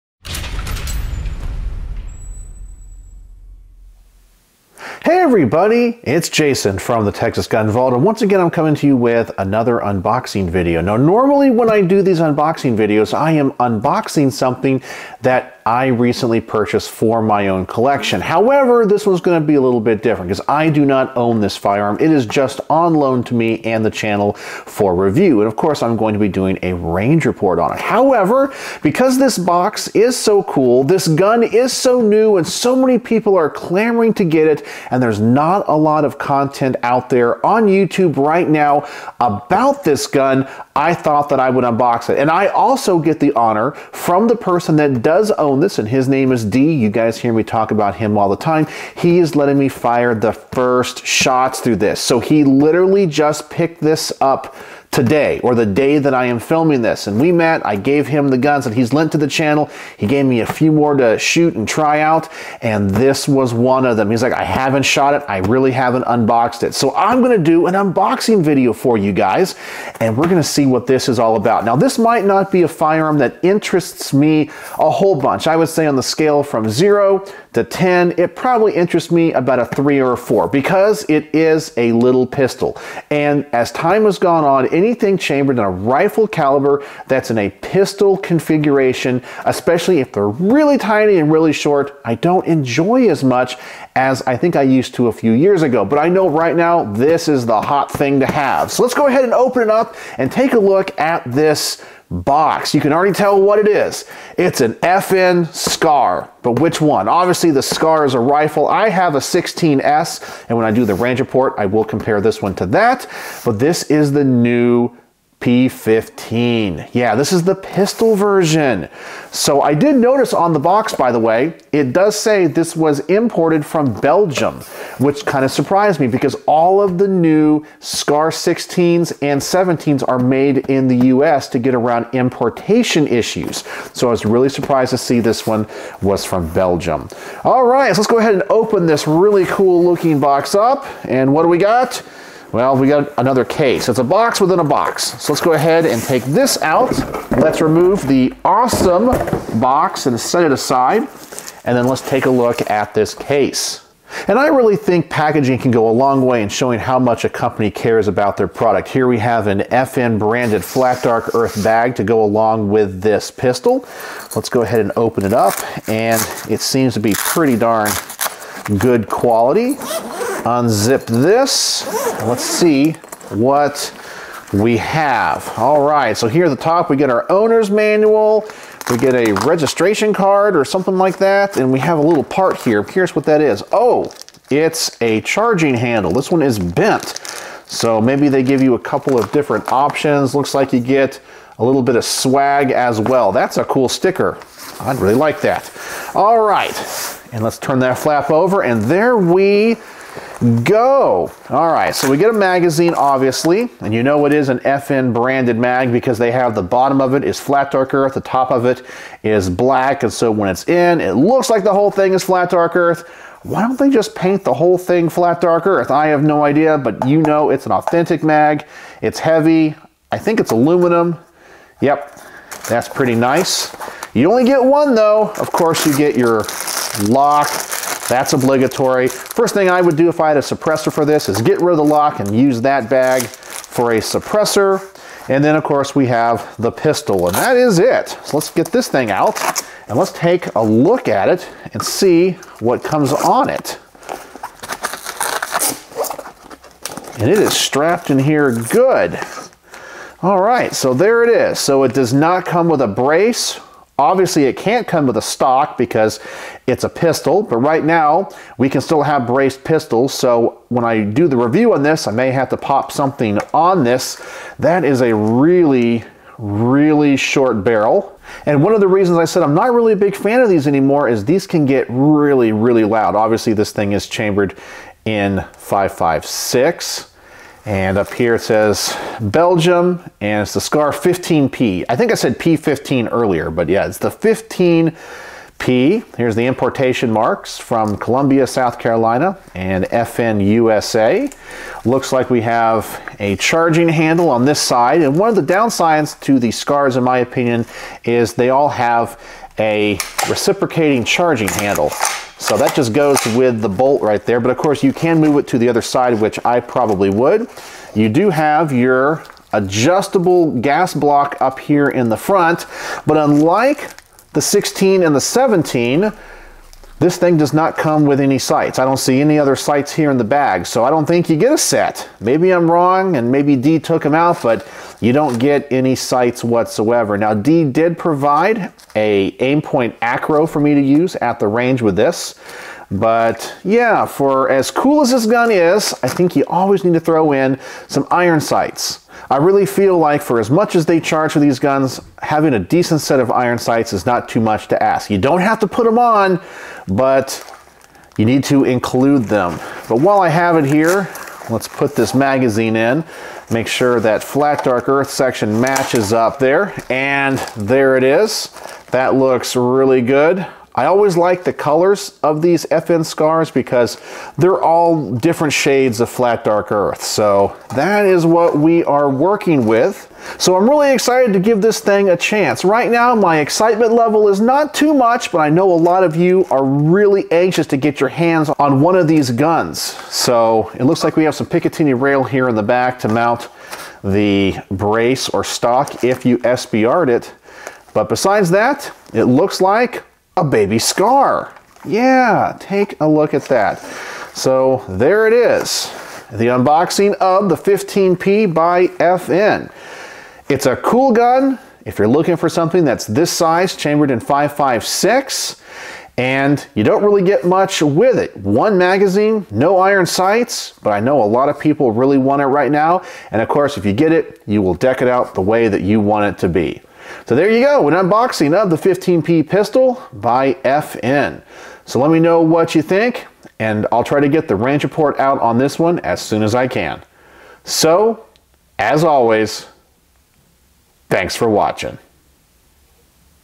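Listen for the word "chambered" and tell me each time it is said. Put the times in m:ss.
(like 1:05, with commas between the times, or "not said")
1:25, 4:34, 6:43.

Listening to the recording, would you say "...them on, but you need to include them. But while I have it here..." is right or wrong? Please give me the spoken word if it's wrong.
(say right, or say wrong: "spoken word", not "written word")
right.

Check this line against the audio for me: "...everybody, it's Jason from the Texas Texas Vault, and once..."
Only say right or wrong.
wrong.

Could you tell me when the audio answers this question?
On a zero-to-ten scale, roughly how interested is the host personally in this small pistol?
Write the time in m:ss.
1:19.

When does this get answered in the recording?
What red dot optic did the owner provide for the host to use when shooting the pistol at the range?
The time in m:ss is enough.
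5:29.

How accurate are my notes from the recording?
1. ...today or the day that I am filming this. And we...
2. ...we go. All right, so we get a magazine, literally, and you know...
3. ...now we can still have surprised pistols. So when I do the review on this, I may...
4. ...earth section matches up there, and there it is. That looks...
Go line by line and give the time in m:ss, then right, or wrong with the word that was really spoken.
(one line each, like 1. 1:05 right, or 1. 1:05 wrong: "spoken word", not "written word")
1. 0:54 right
2. 3:19 wrong: "obviously", not "literally"
3. 4:17 wrong: "braced", not "surprised"
4. 5:54 right.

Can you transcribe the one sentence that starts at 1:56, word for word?
Yeah, this is the pistol version.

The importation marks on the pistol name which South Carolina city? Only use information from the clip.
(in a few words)
Columbia.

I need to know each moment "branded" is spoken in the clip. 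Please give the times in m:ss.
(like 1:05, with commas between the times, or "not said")
2:40, 3:25.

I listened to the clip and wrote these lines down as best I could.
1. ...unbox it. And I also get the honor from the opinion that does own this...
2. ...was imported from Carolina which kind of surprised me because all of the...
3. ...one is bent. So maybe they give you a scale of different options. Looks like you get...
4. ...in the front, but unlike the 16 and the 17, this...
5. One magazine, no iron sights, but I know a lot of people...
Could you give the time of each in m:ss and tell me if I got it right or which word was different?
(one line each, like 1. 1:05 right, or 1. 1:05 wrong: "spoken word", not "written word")
1. 0:41 wrong: "person", not "opinion"
2. 2:02 wrong: "Belgium", not "Carolina"
3. 3:06 wrong: "couple", not "scale"
4. 5:11 right
5. 6:48 right.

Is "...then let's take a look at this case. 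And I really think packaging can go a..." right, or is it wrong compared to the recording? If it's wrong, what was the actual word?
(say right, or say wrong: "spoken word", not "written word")
right.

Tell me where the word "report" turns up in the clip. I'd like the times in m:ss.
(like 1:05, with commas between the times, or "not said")
0:27, 1:51, 7:04.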